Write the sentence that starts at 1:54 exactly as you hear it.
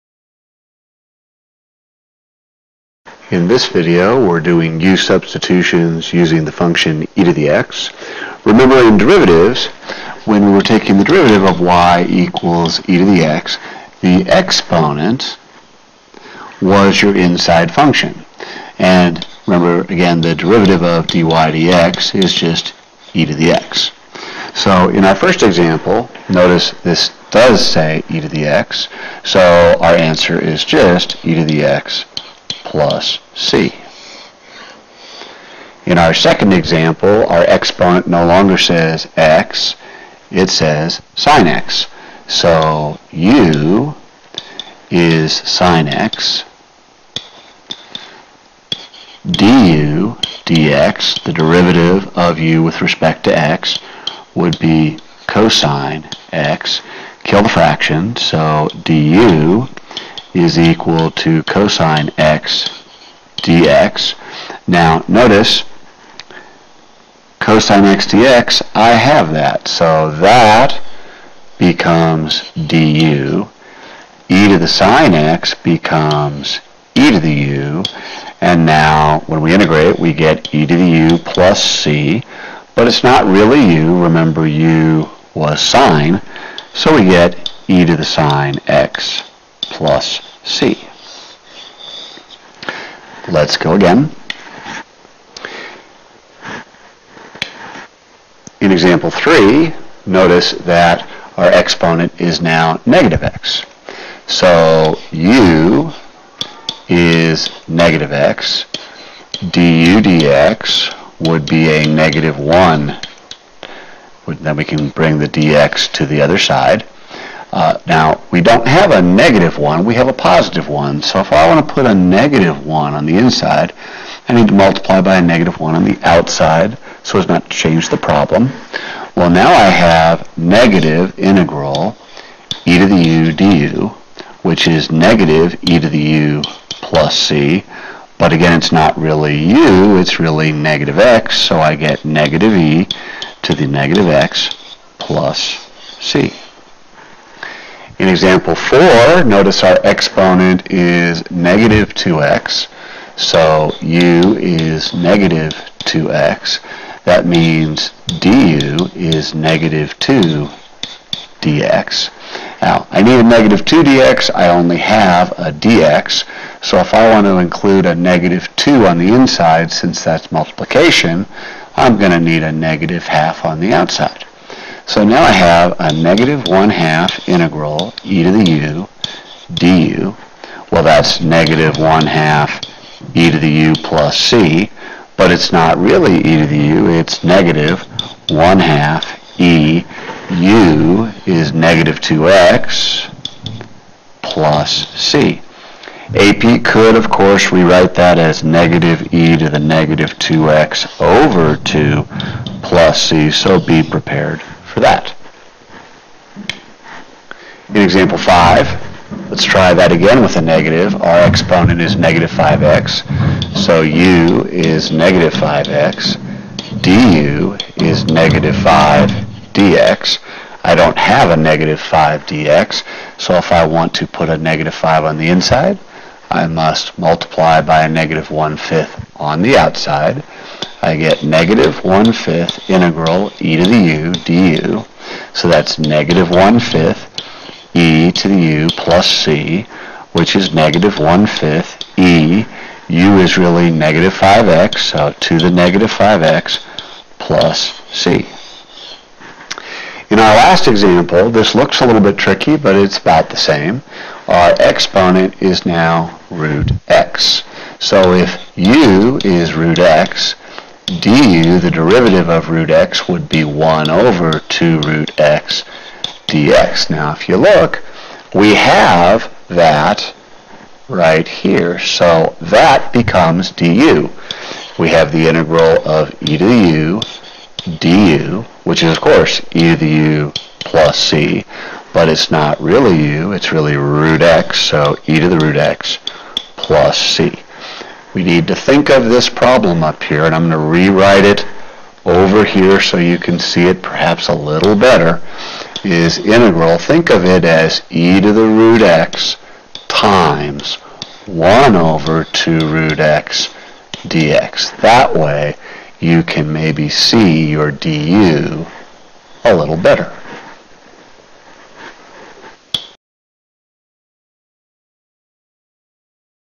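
Then we can bring the dx to the other side.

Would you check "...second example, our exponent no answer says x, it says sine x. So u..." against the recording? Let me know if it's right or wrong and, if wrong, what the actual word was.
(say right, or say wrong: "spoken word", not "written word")
wrong: "longer", not "answer".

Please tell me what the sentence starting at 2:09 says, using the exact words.
Well, now I have negative integral e to the u du, which is negative e to the u plus c.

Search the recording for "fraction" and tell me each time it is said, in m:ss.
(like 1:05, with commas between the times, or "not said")
0:57.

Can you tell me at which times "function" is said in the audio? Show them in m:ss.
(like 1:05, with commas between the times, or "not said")
0:06, 0:17.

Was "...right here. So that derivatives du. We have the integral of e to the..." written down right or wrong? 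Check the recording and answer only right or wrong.
wrong.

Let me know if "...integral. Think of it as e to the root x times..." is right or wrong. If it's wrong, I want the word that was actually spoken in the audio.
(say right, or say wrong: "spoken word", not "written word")
right.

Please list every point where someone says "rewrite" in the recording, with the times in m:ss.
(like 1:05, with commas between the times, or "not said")
3:17, 4:50.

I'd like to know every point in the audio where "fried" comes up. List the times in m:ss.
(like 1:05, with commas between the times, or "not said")
not said.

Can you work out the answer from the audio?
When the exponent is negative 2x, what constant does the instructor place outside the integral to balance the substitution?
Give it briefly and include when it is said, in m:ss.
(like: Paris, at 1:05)
negative half, at 2:52.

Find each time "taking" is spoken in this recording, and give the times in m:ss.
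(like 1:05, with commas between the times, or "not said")
0:10.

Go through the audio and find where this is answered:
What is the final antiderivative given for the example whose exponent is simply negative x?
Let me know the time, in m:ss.
2:22.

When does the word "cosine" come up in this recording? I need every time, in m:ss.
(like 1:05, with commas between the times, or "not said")
0:55, 1:01, 1:07.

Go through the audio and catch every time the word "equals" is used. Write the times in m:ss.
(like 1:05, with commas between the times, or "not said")
0:12, 1:00.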